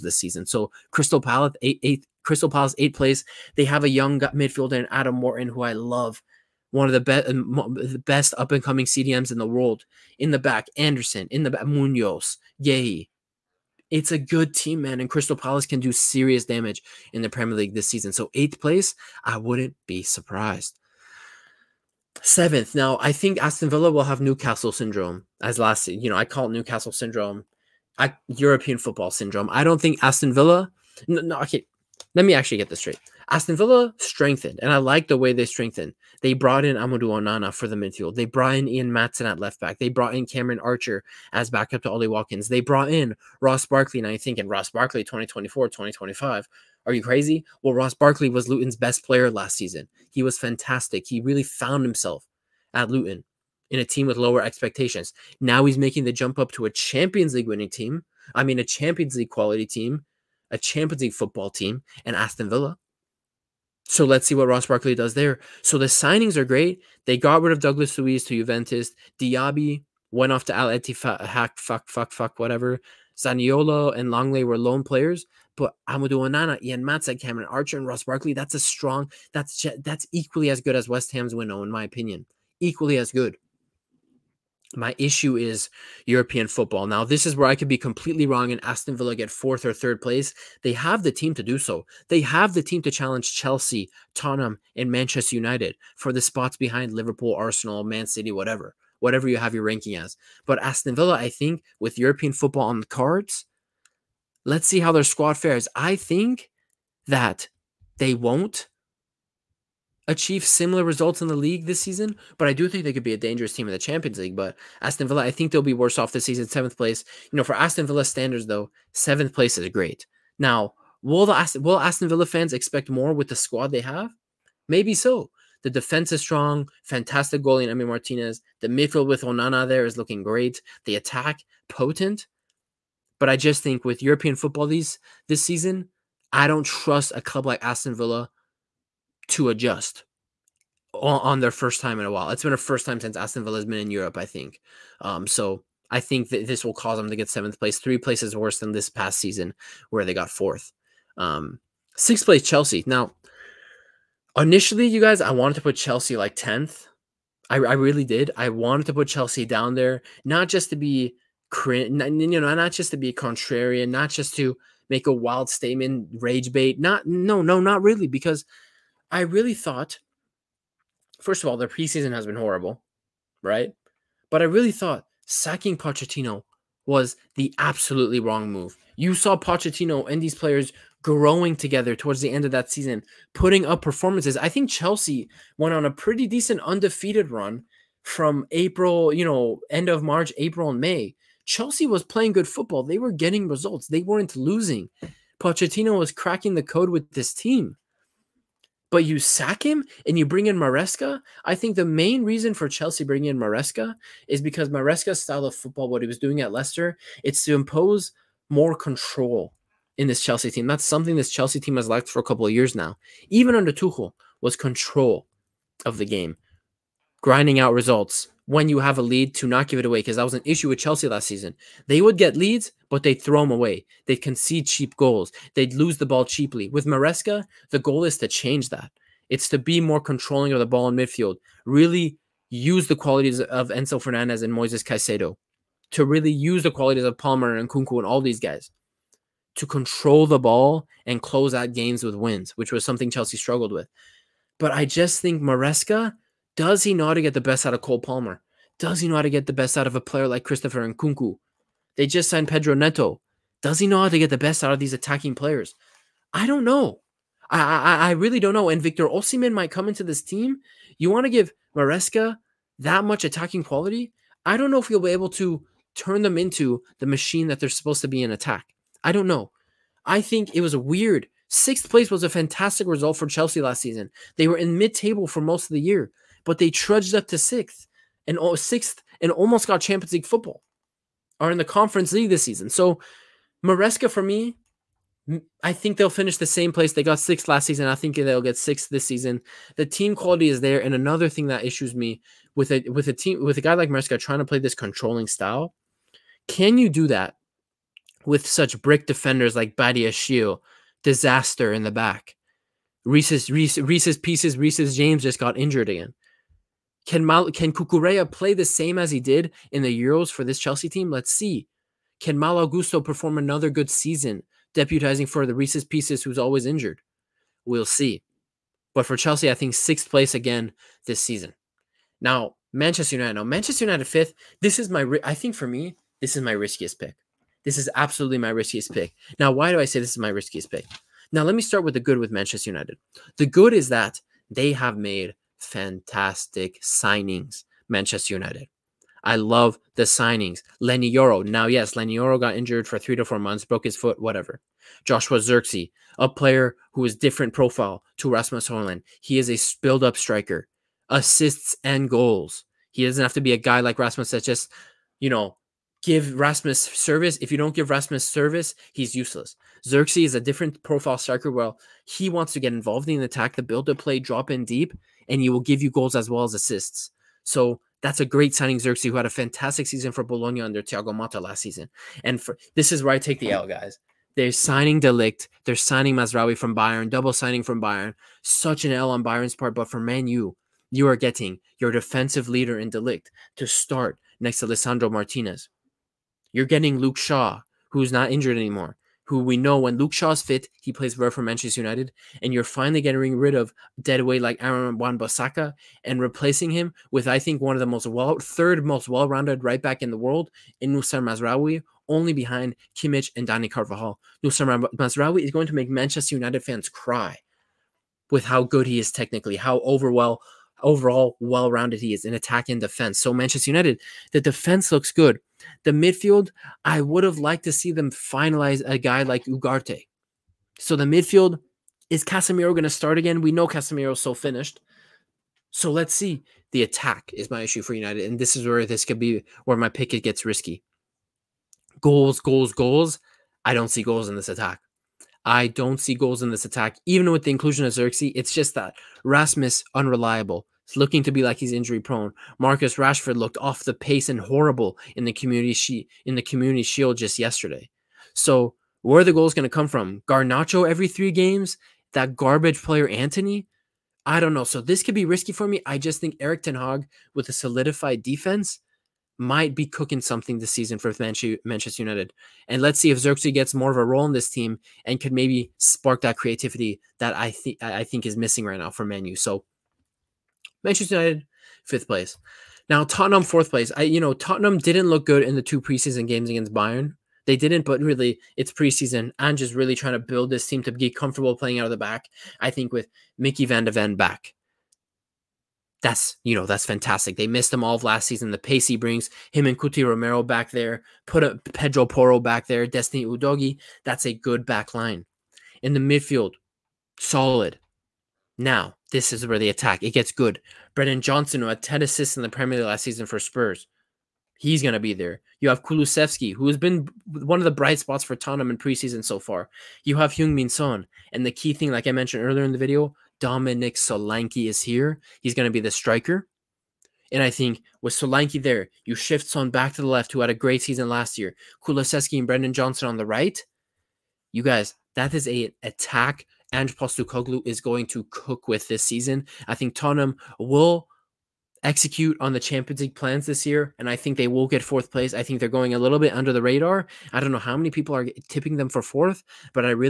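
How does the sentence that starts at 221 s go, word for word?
They would get leads, but they'd throw them away.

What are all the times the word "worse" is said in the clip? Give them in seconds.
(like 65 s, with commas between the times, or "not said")
115 s, 148 s.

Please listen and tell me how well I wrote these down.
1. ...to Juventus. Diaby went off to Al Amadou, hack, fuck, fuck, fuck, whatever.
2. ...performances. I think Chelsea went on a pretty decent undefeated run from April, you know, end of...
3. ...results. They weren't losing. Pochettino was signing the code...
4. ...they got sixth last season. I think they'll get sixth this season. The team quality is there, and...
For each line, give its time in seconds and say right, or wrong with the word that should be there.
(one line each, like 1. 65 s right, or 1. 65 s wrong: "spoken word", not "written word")
1. 68 s wrong: "Ettifaq", not "Amadou"
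2. 183 s right
3. 193 s wrong: "cracking", not "signing"
4. 286 s right.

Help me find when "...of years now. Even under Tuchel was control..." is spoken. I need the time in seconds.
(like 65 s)
212 s.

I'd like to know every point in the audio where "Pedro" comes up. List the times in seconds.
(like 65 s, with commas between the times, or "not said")
252 s, 491 s.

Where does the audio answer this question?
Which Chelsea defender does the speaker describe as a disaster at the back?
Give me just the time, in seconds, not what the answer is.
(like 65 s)
299 s.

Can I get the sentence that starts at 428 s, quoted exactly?
And this is where this could be where my pick it gets risky.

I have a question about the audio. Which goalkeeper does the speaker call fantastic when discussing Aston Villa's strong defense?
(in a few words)
Emi Martinez.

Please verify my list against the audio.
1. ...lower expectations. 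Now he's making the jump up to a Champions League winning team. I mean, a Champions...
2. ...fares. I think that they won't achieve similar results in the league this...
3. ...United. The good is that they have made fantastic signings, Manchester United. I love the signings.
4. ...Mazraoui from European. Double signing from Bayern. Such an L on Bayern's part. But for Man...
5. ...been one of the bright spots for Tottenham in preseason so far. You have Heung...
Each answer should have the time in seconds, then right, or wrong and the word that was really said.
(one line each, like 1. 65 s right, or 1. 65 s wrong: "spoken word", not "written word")
1. 54 s right
2. 105 s right
3. 332 s right
4. 376 s wrong: "Bayern", not "European"
5. 506 s right.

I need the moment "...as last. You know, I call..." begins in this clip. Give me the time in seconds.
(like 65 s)
25 s.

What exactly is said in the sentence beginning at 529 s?
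I think Tottenham will execute on the Champions League plans this year, and I think they will get fourth place.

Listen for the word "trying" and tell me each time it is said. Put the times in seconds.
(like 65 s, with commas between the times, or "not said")
294 s, 479 s.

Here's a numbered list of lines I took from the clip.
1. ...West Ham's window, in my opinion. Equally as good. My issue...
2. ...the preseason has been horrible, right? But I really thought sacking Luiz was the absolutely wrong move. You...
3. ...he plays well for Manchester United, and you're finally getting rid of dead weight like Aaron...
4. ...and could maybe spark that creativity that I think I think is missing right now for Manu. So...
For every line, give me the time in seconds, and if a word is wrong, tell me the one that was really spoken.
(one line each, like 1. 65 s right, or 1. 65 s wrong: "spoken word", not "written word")
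1. 80 s right
2. 171 s wrong: "Pochettino", not "Luiz"
3. 390 s right
4. 465 s right.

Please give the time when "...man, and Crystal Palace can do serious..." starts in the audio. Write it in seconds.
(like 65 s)
14 s.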